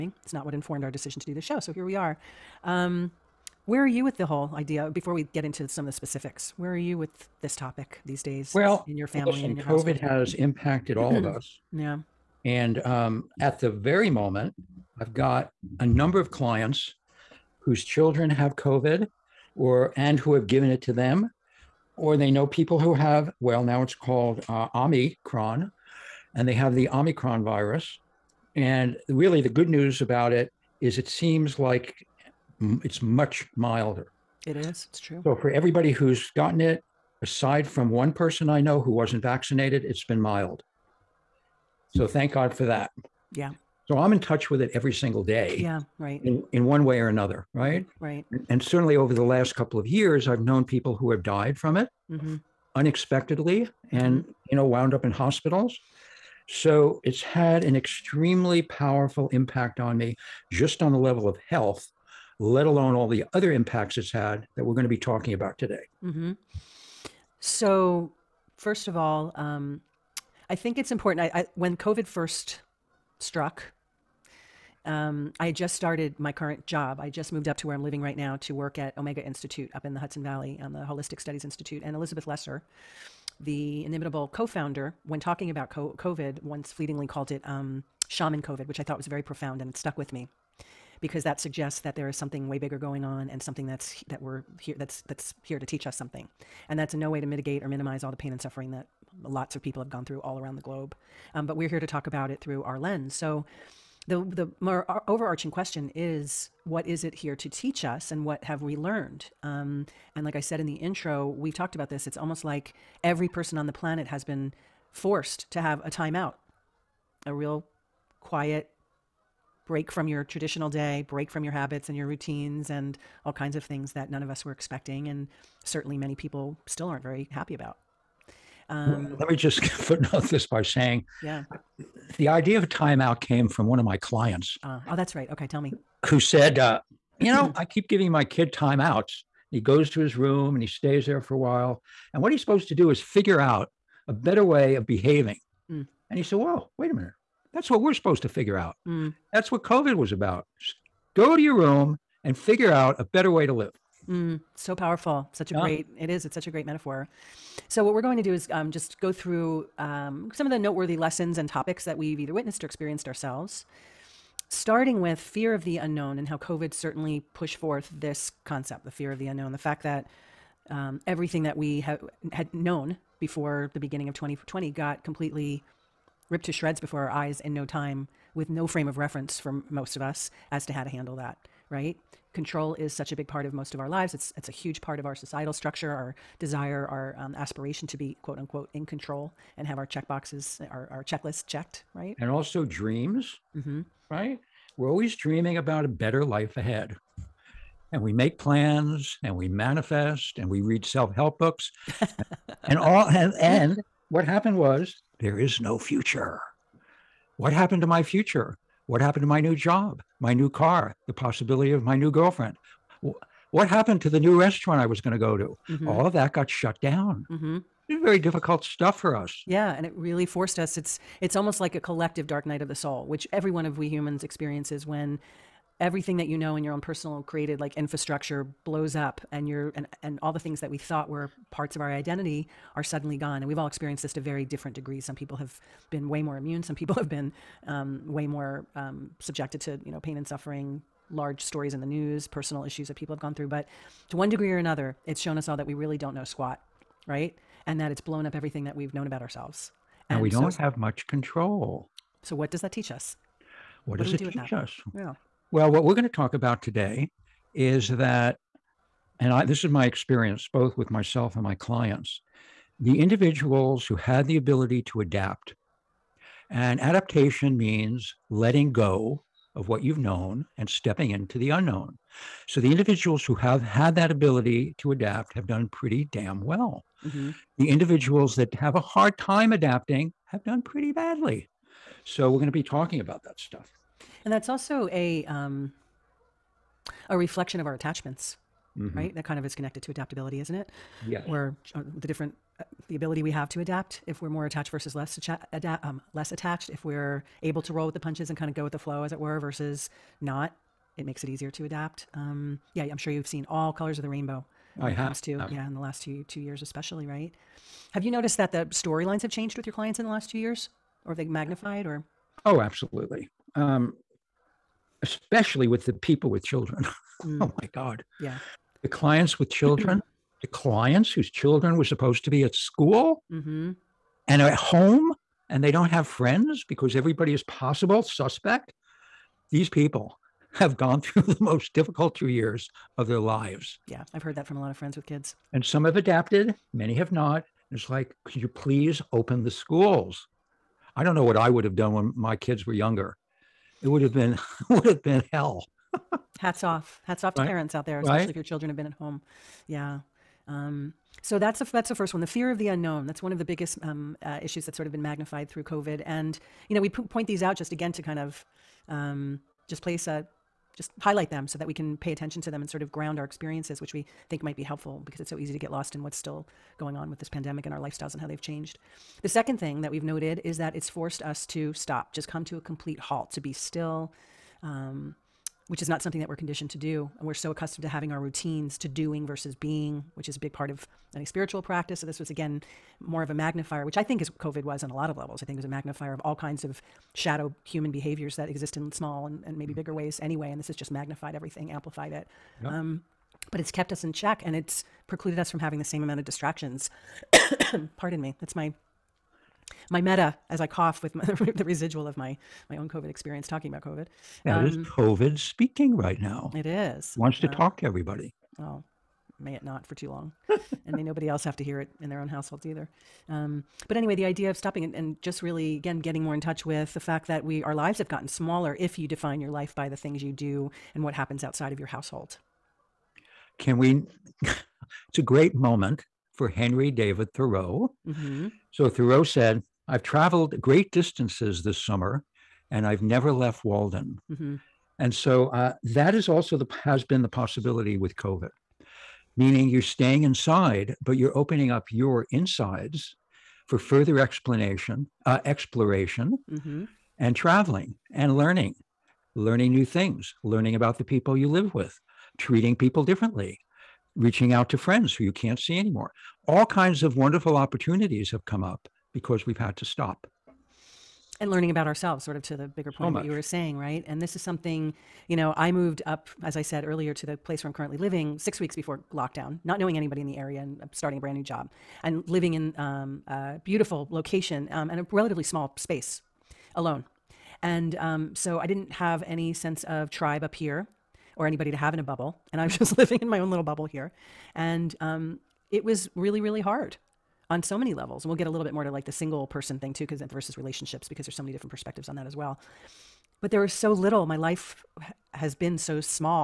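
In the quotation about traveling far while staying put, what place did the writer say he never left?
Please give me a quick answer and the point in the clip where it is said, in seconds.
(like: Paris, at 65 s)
Walden, at 433 s.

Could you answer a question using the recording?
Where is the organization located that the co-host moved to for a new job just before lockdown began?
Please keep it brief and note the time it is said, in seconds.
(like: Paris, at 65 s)
Hudson Valley, at 79 s.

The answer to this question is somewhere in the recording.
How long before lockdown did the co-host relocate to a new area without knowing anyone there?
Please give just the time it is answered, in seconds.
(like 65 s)
468 s.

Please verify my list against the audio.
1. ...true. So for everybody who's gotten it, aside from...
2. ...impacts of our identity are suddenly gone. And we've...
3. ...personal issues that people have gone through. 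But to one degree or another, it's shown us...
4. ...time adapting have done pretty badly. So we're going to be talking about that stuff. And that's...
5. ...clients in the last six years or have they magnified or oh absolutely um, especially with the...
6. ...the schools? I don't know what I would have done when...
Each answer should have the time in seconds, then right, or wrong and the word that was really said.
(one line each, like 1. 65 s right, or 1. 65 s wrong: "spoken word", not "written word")
1. 34 s right
2. 231 s wrong: "parts", not "impacts"
3. 242 s right
4. 279 s right
5. 309 s wrong: "two", not "six"
6. 339 s right.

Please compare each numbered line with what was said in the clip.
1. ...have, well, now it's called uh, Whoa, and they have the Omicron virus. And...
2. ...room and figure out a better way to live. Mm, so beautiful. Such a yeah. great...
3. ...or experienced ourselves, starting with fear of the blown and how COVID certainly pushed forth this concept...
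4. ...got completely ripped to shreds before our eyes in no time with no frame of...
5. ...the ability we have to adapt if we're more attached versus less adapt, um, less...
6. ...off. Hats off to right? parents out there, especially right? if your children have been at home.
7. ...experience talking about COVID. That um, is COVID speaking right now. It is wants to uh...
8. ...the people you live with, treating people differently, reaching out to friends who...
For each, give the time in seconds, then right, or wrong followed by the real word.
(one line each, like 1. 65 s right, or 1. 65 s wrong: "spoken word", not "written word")
1. 22 s wrong: "Omicron", not "Whoa"
2. 151 s wrong: "powerful", not "beautiful"
3. 162 s wrong: "unknown", not "blown"
4. 174 s right
5. 292 s right
6. 346 s right
7. 403 s right
8. 450 s right.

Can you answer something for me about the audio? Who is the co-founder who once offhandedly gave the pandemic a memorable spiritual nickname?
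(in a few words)
Elizabeth Lesser.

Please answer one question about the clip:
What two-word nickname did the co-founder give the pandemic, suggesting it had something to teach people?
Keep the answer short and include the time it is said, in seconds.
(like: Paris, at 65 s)
Shaman COVID, at 88 s.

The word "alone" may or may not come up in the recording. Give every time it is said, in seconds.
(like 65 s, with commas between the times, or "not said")
62 s, 476 s.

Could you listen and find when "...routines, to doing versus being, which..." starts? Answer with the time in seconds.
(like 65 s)
378 s.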